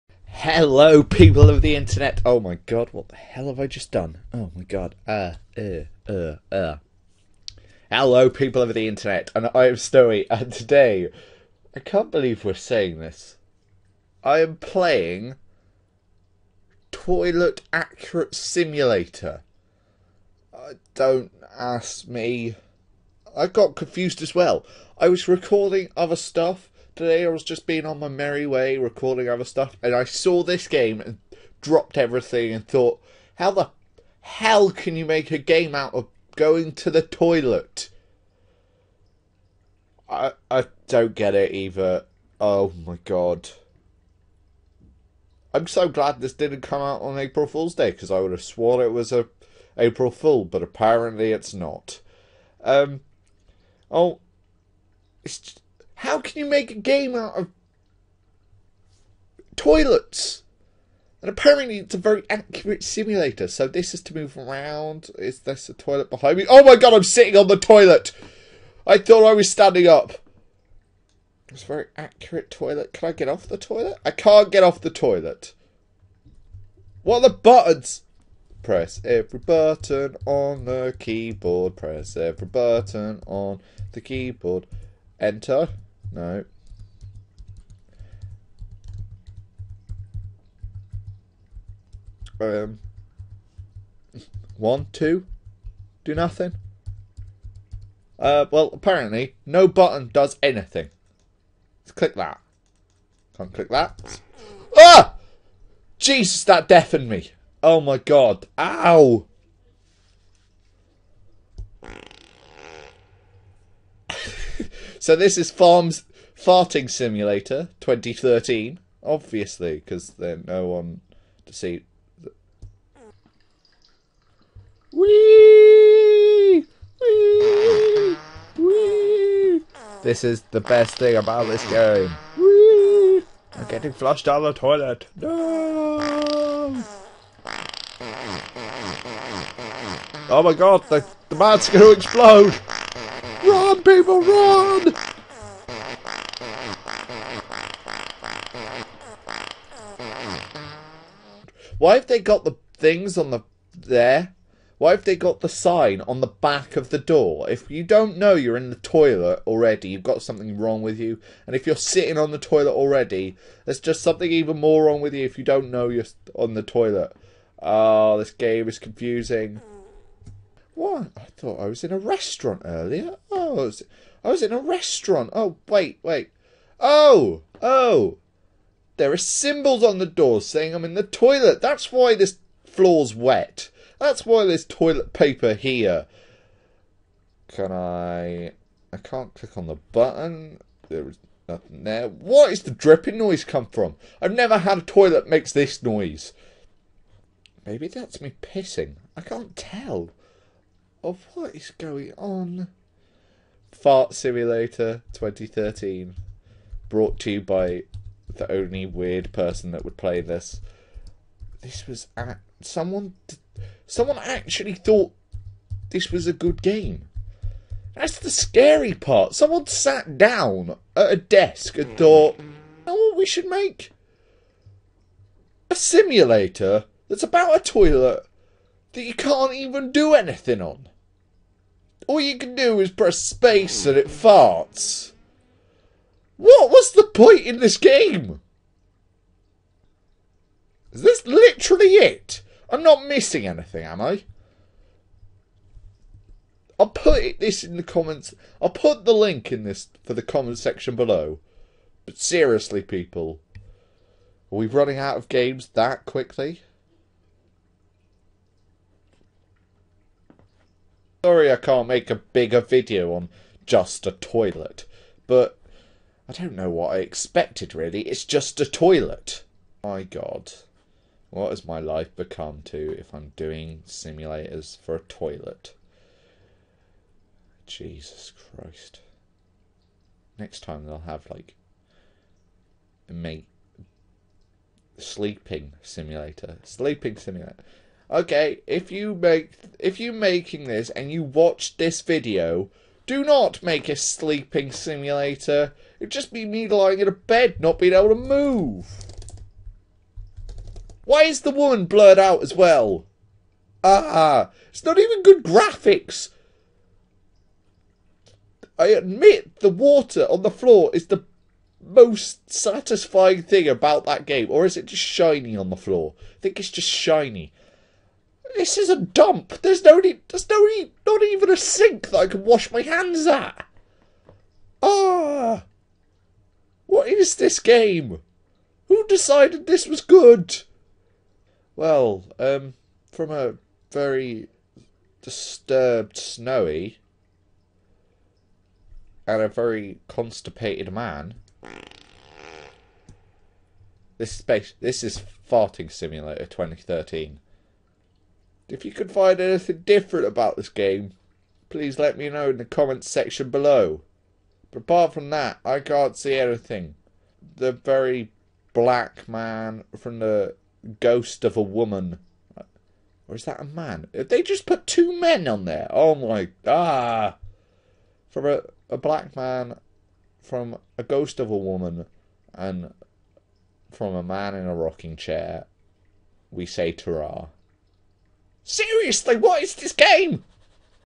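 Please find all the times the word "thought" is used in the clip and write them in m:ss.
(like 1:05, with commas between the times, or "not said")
0:32, 1:08, 2:51, 3:34, 3:41.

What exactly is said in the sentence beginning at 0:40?
I I don't get it either.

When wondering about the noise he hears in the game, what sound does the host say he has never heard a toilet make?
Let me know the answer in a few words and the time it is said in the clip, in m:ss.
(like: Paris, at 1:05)
dripping, at 3:12.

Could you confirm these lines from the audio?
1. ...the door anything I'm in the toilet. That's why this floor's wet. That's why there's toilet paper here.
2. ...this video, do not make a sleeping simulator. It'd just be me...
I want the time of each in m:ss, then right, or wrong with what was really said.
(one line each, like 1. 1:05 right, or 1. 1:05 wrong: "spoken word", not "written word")
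1. 2:59 wrong: "saying", not "anything"
2. 4:51 right.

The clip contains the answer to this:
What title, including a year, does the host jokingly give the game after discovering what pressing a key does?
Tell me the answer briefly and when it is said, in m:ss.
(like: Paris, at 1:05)
Farms Farting Simulator 2013, at 1:55.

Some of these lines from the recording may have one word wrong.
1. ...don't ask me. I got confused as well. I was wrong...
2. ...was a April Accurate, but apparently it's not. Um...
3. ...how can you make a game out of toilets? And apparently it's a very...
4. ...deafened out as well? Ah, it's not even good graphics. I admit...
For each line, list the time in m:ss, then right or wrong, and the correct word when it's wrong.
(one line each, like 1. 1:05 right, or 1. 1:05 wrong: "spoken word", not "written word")
1. 0:20 wrong: "recording", not "wrong"
2. 0:48 wrong: "Fool", not "Accurate"
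3. 0:56 right
4. 5:01 wrong: "blurred", not "deafened".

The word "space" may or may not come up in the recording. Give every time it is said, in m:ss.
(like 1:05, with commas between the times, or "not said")
3:53, 5:44.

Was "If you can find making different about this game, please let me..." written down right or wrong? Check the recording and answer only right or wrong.
wrong.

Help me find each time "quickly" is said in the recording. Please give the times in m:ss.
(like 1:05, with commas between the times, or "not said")
4:16.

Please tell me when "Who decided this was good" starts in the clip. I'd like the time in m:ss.
5:28.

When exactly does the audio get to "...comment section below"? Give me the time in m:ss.
4:10.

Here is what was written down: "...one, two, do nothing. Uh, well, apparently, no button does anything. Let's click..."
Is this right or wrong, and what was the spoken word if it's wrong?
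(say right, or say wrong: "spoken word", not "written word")
right.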